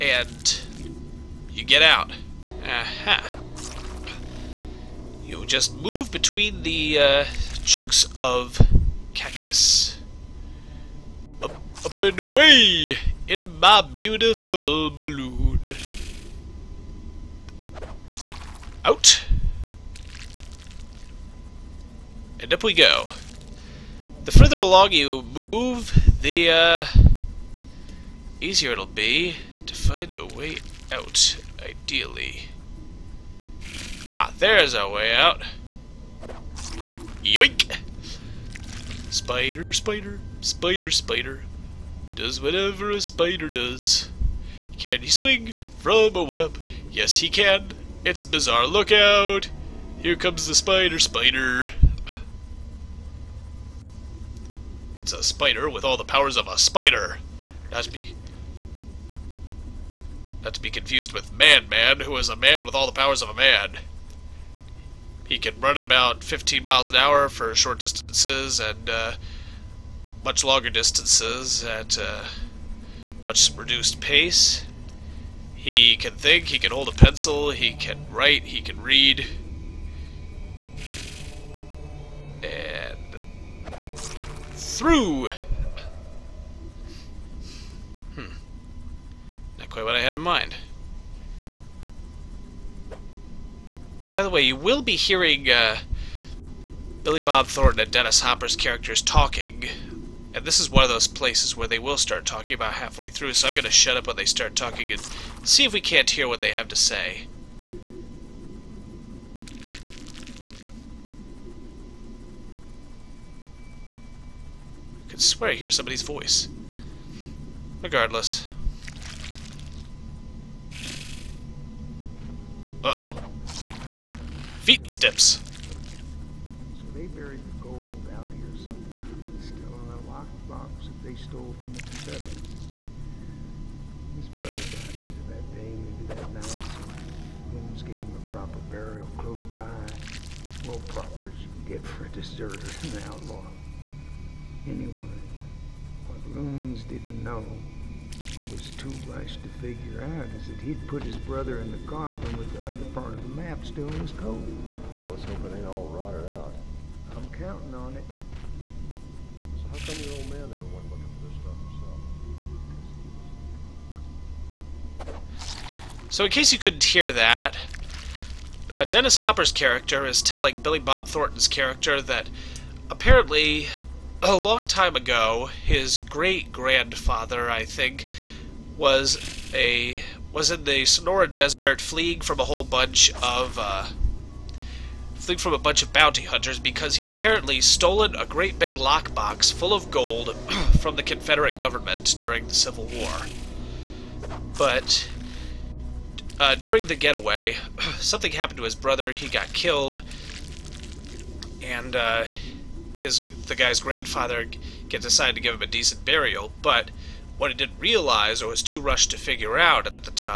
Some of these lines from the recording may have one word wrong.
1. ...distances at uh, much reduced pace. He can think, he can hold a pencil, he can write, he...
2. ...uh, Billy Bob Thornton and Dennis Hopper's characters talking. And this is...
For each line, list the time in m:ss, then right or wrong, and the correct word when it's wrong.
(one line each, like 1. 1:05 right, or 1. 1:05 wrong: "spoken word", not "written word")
1. 1:10 right
2. 1:35 right.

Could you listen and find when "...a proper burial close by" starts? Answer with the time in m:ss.
2:18.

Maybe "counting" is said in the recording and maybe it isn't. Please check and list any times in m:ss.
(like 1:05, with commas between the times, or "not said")
2:37.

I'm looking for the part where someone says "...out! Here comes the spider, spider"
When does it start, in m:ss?
0:48.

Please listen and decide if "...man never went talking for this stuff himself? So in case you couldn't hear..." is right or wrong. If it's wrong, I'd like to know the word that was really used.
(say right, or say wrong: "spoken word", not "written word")
wrong: "looking", not "talking".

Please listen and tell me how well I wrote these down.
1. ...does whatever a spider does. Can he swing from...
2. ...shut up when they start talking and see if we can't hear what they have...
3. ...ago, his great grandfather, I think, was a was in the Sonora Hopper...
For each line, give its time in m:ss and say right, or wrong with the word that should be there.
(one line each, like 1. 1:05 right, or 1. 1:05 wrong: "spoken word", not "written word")
1. 0:42 right
2. 1:43 right
3. 2:54 wrong: "Desert", not "Hopper".